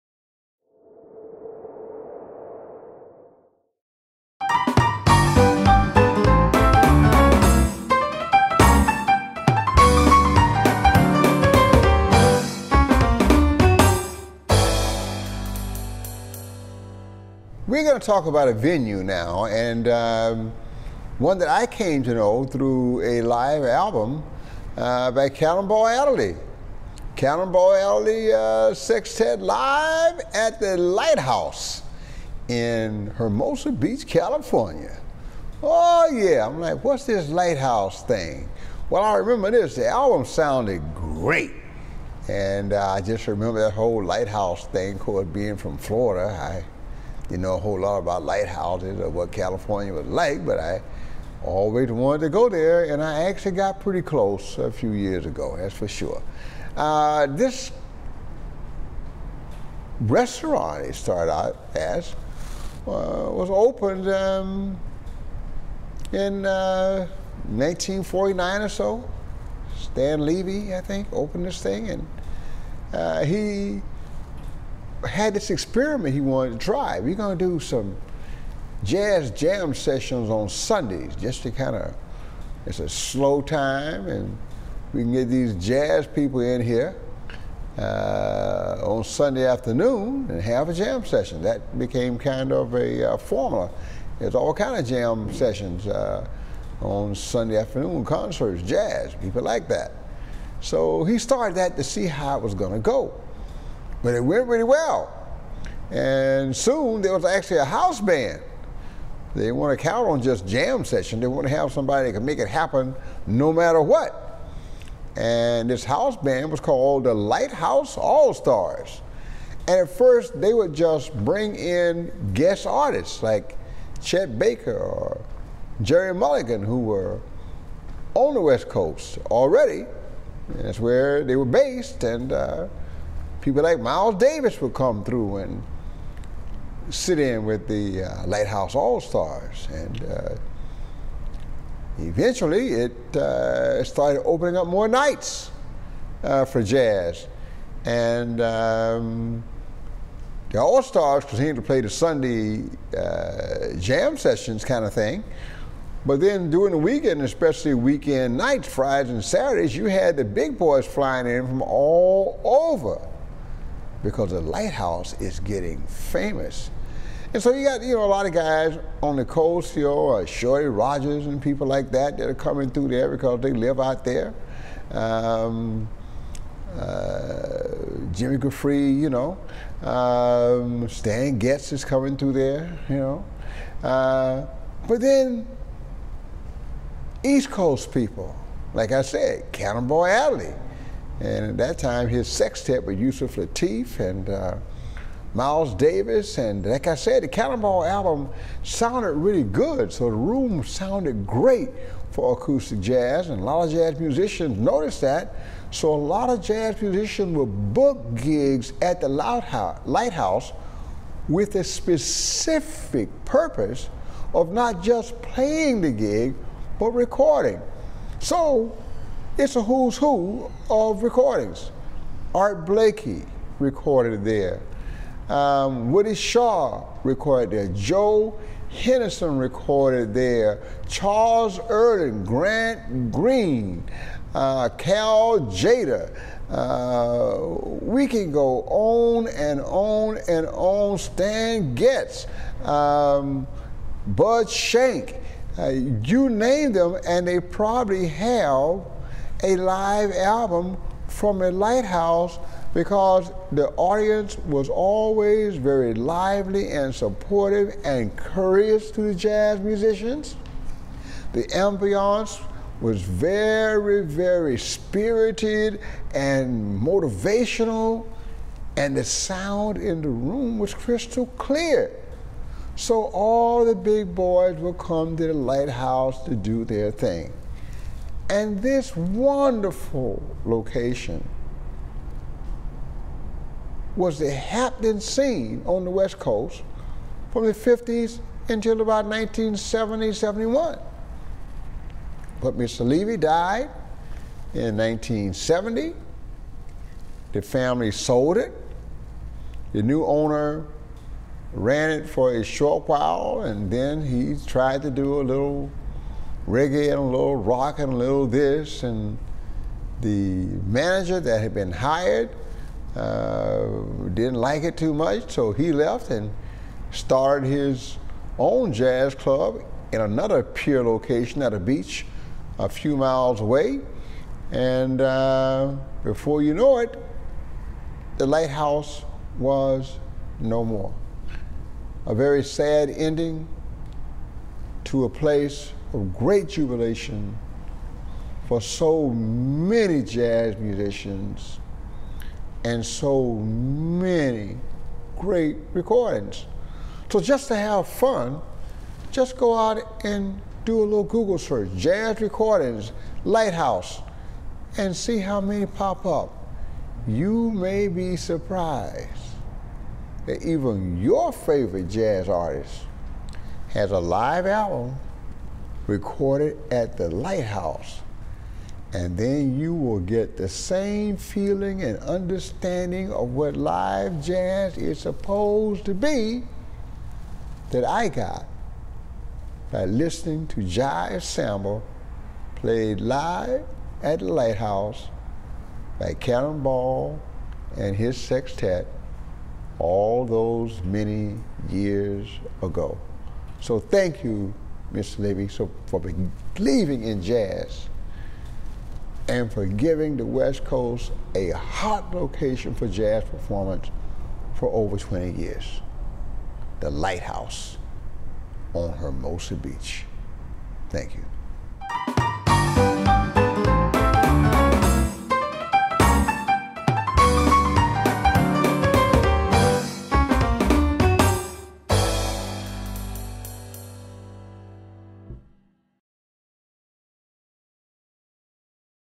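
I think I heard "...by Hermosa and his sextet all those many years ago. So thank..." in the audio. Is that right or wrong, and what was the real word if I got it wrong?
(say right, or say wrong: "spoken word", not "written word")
wrong: "Cannonball", not "Hermosa".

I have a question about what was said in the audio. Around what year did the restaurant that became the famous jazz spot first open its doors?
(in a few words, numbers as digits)
1949.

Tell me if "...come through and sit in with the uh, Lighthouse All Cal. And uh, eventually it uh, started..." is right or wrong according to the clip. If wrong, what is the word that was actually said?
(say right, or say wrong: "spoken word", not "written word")
wrong: "Stars", not "Cal".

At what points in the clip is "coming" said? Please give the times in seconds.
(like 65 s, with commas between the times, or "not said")
172 s, 181 s.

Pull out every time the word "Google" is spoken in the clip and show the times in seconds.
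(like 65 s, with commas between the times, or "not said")
351 s.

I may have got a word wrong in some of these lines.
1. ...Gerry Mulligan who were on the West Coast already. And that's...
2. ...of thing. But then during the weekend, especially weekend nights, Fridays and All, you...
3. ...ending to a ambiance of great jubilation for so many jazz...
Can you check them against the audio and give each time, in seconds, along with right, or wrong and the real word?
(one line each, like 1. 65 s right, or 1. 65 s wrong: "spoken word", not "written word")
1. 125 s right
2. 154 s wrong: "Saturdays", not "All"
3. 332 s wrong: "place", not "ambiance".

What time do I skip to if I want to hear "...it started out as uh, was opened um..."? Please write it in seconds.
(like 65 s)
60 s.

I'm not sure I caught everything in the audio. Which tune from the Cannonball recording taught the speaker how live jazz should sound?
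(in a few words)
Jive Samba.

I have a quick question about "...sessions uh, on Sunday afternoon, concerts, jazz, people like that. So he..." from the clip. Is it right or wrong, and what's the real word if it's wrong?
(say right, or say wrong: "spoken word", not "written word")
right.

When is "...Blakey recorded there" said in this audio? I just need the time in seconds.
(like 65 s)
222 s.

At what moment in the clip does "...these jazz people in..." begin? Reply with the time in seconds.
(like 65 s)
85 s.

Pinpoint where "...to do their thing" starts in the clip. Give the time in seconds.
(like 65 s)
276 s.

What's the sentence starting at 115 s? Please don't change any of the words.
And this house band was called the Lighthouse All Stars.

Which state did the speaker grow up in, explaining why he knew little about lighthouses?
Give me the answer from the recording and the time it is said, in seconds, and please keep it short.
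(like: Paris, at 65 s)
Florida, at 45 s.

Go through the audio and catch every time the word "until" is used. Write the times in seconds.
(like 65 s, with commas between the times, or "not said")
288 s.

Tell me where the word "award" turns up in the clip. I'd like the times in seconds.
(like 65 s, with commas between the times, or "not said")
not said.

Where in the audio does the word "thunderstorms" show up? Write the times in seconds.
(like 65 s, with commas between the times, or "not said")
not said.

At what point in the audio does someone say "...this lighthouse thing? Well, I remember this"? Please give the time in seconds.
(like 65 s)
37 s.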